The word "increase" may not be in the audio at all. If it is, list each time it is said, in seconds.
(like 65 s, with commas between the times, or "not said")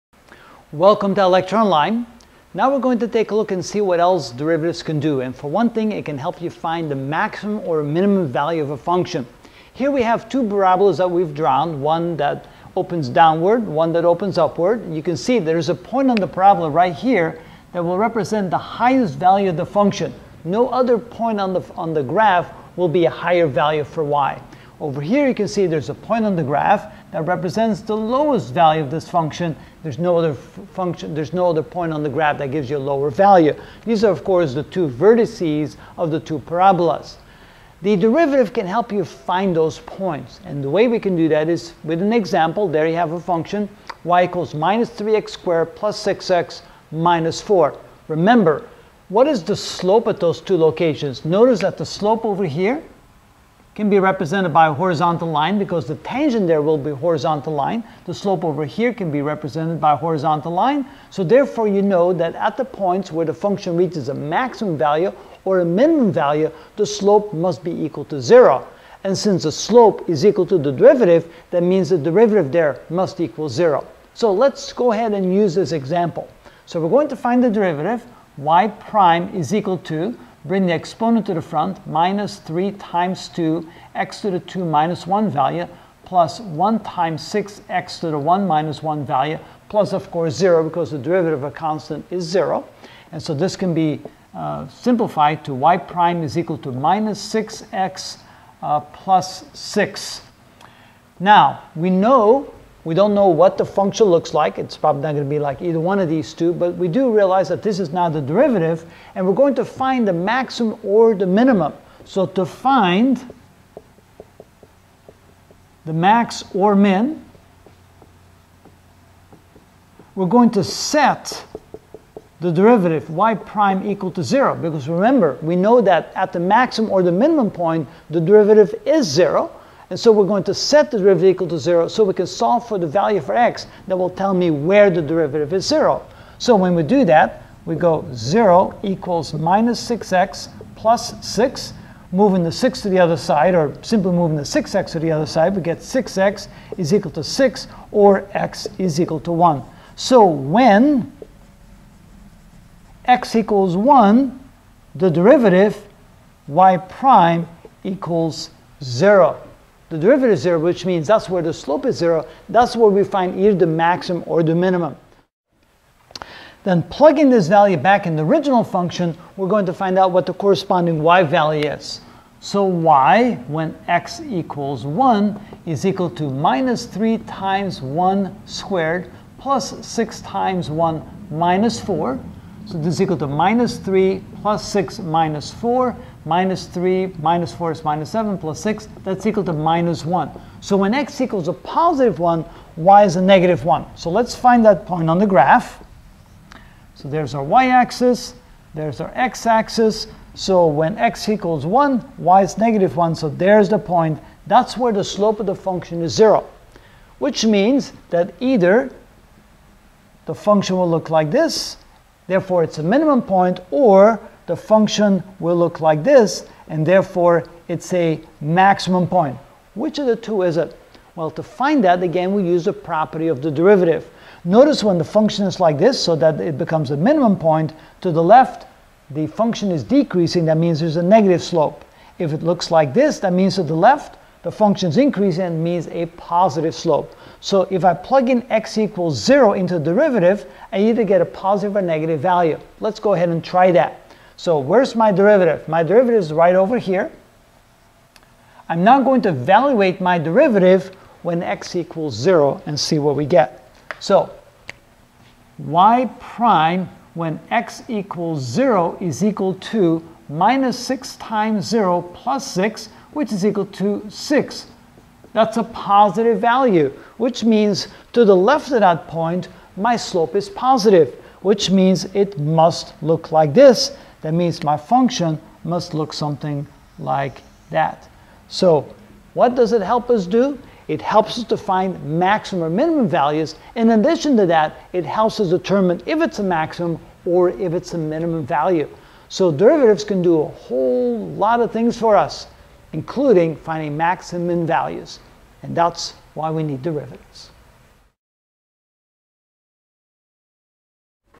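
234 s.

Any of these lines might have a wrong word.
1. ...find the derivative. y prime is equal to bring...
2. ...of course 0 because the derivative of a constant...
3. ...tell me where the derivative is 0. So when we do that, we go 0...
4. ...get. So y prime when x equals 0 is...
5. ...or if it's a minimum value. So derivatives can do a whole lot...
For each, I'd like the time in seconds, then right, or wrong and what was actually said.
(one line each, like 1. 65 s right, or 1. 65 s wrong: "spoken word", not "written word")
1. 77 s right
2. 89 s right
3. 134 s right
4. 253 s right
5. 287 s right.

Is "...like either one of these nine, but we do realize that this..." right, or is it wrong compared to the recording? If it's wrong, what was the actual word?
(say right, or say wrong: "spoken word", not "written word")
wrong: "two", not "nine".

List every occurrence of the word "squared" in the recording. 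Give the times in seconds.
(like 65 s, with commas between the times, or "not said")
45 s, 178 s.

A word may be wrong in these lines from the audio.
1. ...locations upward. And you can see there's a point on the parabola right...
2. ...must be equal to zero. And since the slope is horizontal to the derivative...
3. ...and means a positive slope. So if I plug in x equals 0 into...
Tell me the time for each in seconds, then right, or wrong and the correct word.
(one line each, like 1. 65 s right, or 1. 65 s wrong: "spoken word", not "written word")
1. 14 s wrong: "opens", not "locations"
2. 67 s wrong: "equal", not "horizontal"
3. 235 s right.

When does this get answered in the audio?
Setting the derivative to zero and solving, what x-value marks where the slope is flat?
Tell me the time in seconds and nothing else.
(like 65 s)
148 s.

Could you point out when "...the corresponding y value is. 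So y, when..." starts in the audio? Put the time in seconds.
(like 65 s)
170 s.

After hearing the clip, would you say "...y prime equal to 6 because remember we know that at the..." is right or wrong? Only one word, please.
wrong.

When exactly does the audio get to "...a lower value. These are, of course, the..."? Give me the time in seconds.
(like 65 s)
32 s.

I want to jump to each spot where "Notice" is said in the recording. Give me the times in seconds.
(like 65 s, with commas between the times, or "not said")
51 s, 224 s.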